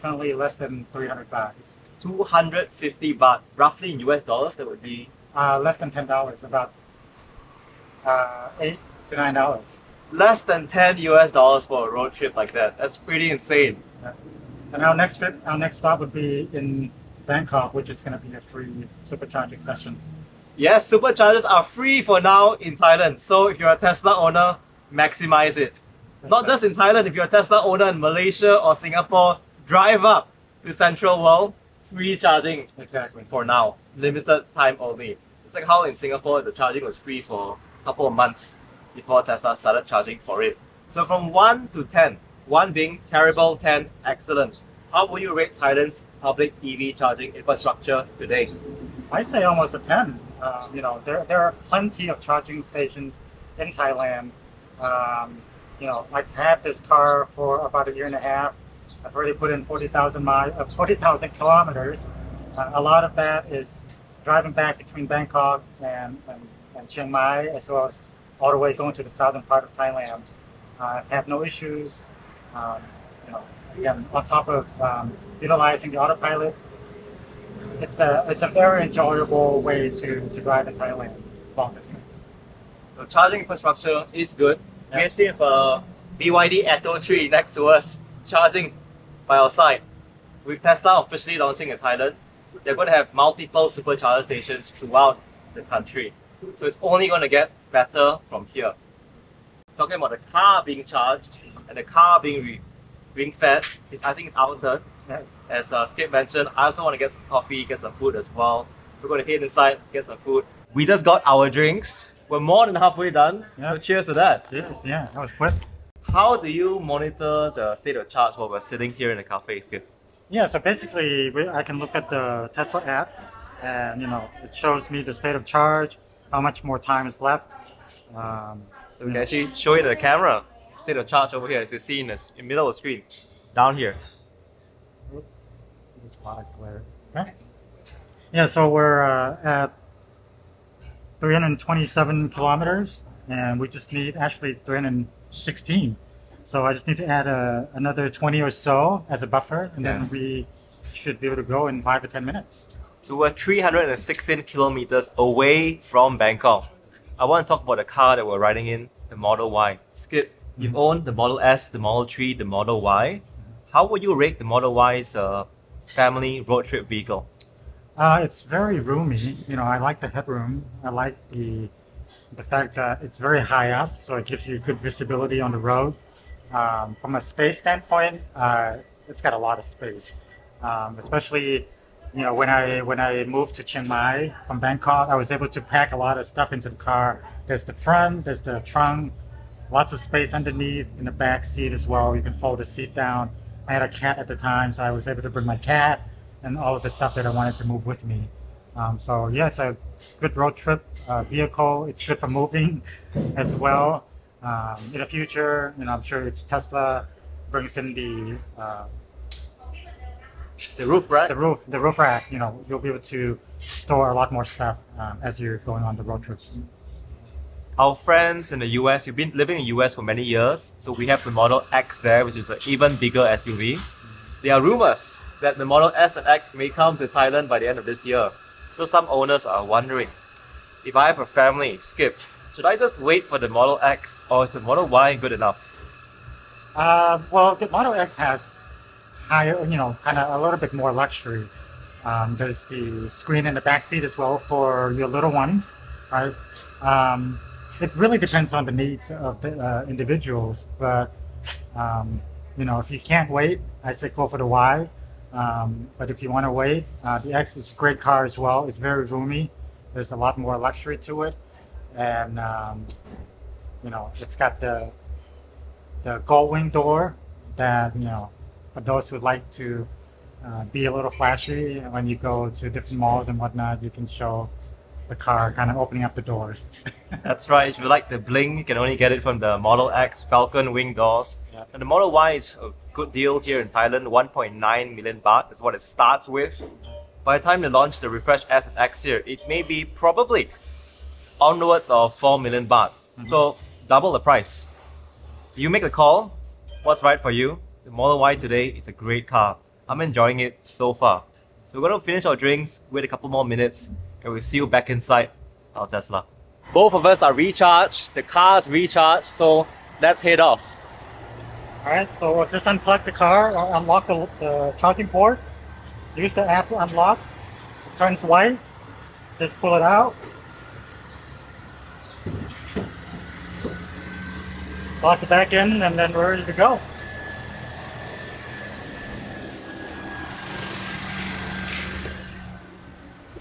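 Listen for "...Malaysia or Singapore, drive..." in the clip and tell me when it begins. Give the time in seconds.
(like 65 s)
27 s.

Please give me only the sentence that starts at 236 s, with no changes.
Uh, well, the Model X has higher, you know, kind of a little bit more luxury.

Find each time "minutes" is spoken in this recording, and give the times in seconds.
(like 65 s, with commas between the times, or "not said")
152 s, 303 s.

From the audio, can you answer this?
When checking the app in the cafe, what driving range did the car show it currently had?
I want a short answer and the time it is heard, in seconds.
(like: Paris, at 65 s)
327 kilometers, at 141 s.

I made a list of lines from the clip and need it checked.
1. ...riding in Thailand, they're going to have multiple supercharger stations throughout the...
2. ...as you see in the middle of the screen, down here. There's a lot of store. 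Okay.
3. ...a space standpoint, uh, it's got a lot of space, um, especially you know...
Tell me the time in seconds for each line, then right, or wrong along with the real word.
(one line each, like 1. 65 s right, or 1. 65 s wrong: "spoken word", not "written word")
1. 91 s wrong: "launching", not "riding"
2. 131 s wrong: "glare", not "store"
3. 177 s right.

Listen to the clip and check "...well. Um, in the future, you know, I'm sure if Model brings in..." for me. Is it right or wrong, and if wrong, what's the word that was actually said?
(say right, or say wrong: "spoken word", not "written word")
wrong: "Tesla", not "Model".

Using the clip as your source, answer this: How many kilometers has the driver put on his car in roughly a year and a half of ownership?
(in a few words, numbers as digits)
40,000 kilometers.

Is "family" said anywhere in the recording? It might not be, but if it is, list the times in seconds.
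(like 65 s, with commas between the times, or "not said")
165 s, 231 s.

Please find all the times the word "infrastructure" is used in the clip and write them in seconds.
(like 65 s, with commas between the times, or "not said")
47 s, 83 s.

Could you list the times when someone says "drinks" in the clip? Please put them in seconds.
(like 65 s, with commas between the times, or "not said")
111 s, 302 s.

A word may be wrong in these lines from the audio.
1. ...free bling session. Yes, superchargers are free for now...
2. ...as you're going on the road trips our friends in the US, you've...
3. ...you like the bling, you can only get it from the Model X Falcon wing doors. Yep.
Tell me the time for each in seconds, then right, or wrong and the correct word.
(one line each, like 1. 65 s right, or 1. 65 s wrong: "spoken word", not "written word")
1. 18 s wrong: "supercharging", not "bling"
2. 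215 s right
3. 277 s right.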